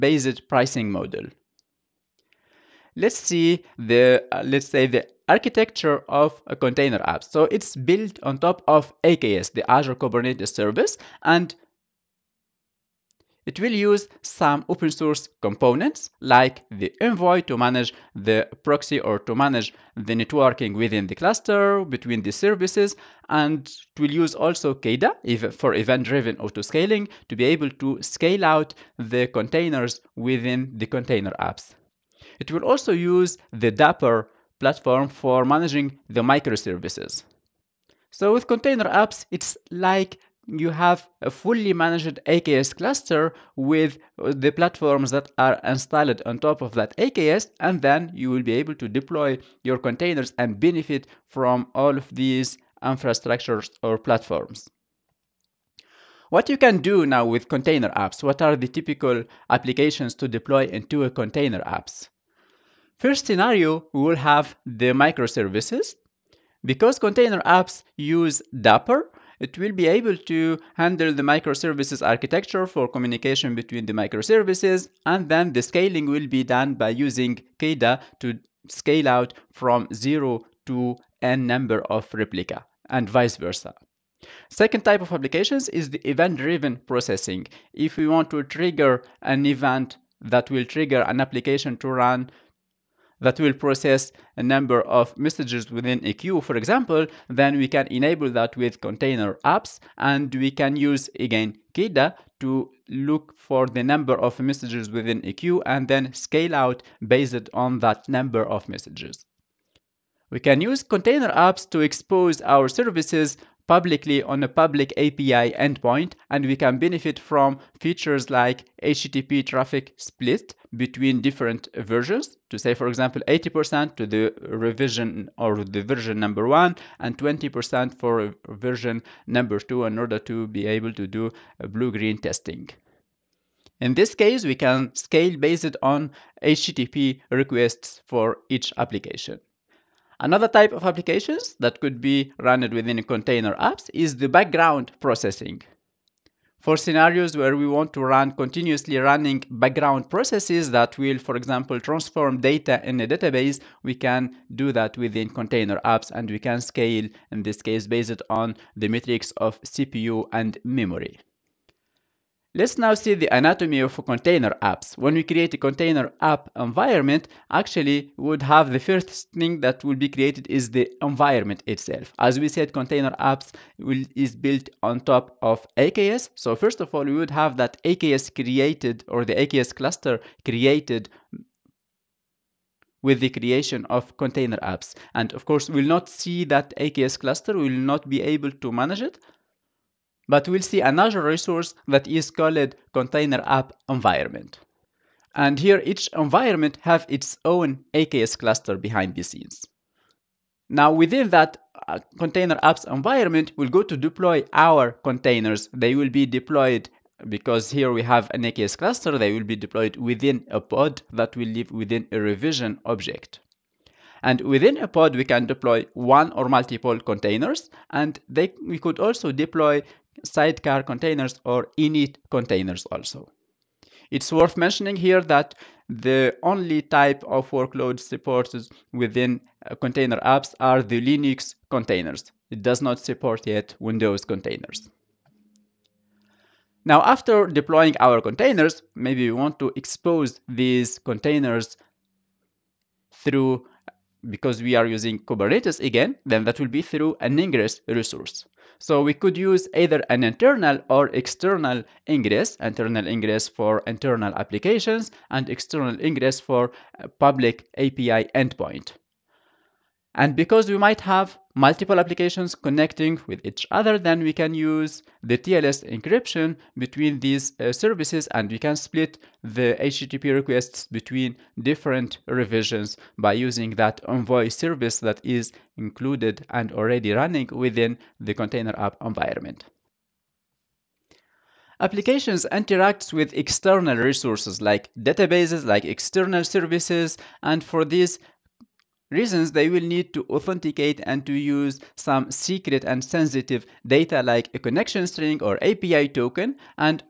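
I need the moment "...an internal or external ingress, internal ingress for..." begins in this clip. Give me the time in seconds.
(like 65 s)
250 s.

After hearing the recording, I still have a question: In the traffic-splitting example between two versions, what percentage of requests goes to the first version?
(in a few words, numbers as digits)
80%.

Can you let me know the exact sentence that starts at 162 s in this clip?
Let's now see the anatomy of container apps.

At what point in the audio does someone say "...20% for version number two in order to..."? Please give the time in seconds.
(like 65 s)
127 s.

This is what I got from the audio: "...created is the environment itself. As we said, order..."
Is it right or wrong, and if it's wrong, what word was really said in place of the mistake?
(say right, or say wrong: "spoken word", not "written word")
wrong: "container", not "order".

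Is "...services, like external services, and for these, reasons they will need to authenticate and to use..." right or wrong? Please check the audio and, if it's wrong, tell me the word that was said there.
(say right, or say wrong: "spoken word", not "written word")
wrong: "databases", not "services".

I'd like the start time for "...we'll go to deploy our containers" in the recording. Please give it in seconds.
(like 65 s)
203 s.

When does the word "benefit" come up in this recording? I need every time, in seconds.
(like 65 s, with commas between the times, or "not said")
50 s, 116 s.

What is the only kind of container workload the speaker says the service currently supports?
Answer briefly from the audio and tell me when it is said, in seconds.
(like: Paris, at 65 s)
Linux containers, at 230 s.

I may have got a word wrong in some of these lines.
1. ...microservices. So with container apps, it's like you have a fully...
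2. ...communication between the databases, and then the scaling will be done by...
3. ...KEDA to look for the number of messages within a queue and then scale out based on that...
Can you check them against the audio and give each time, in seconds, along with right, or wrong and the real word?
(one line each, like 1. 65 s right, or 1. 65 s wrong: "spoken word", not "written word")
1. 36 s right
2. 72 s wrong: "microservices", not "databases"
3. 101 s right.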